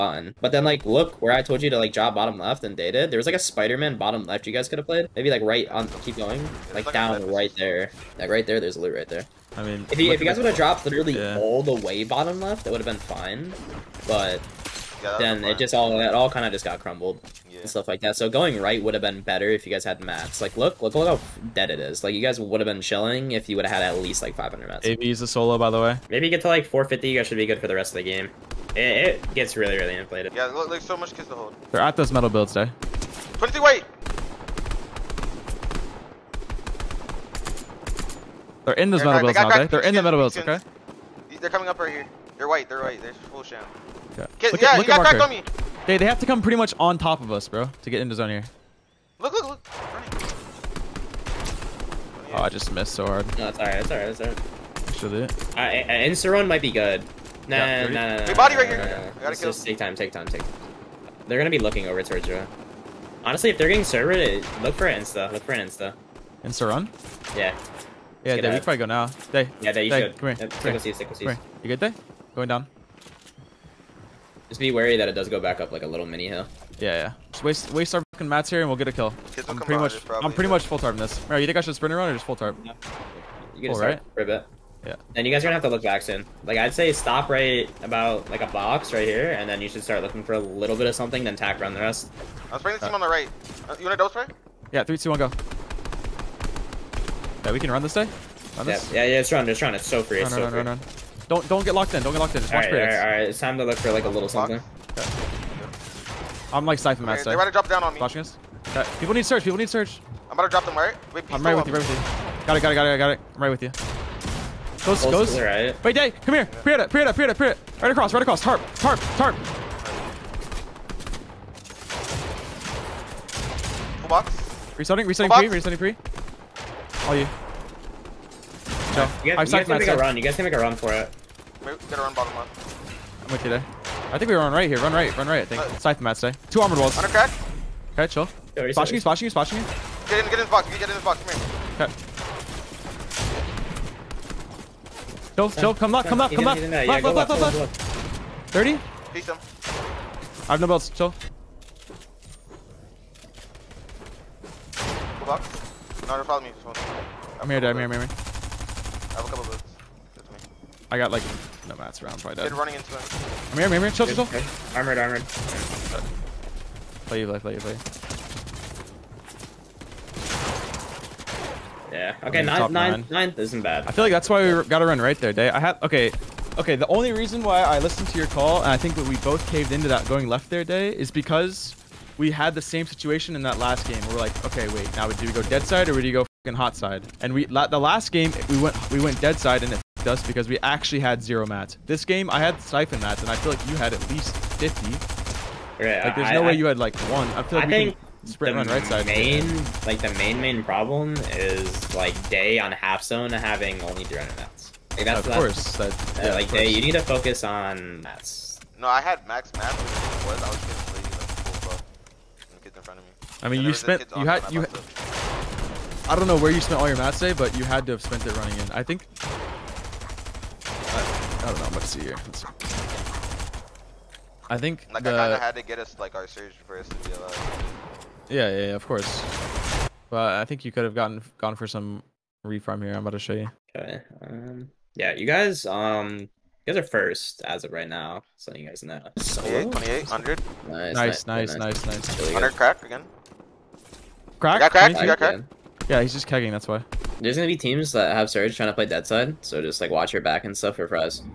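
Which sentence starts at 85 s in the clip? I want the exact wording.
And you guys are gonna have to look back soon.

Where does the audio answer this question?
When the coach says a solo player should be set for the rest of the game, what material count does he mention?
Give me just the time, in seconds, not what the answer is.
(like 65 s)
26 s.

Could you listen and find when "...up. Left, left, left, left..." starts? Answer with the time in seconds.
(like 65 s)
146 s.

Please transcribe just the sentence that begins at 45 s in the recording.
They, they have to come pretty much on top of us, bro, to get into zone here.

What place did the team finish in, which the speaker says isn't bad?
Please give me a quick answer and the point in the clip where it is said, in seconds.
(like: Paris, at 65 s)
9th, at 172 s.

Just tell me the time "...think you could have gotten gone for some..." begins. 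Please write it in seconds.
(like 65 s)
230 s.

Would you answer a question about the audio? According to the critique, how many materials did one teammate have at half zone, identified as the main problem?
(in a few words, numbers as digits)
300.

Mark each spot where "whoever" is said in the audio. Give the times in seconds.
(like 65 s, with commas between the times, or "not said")
not said.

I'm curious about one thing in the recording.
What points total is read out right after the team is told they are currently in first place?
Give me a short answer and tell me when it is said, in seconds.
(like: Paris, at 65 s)
2800, at 239 s.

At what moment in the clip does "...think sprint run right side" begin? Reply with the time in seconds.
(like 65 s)
197 s.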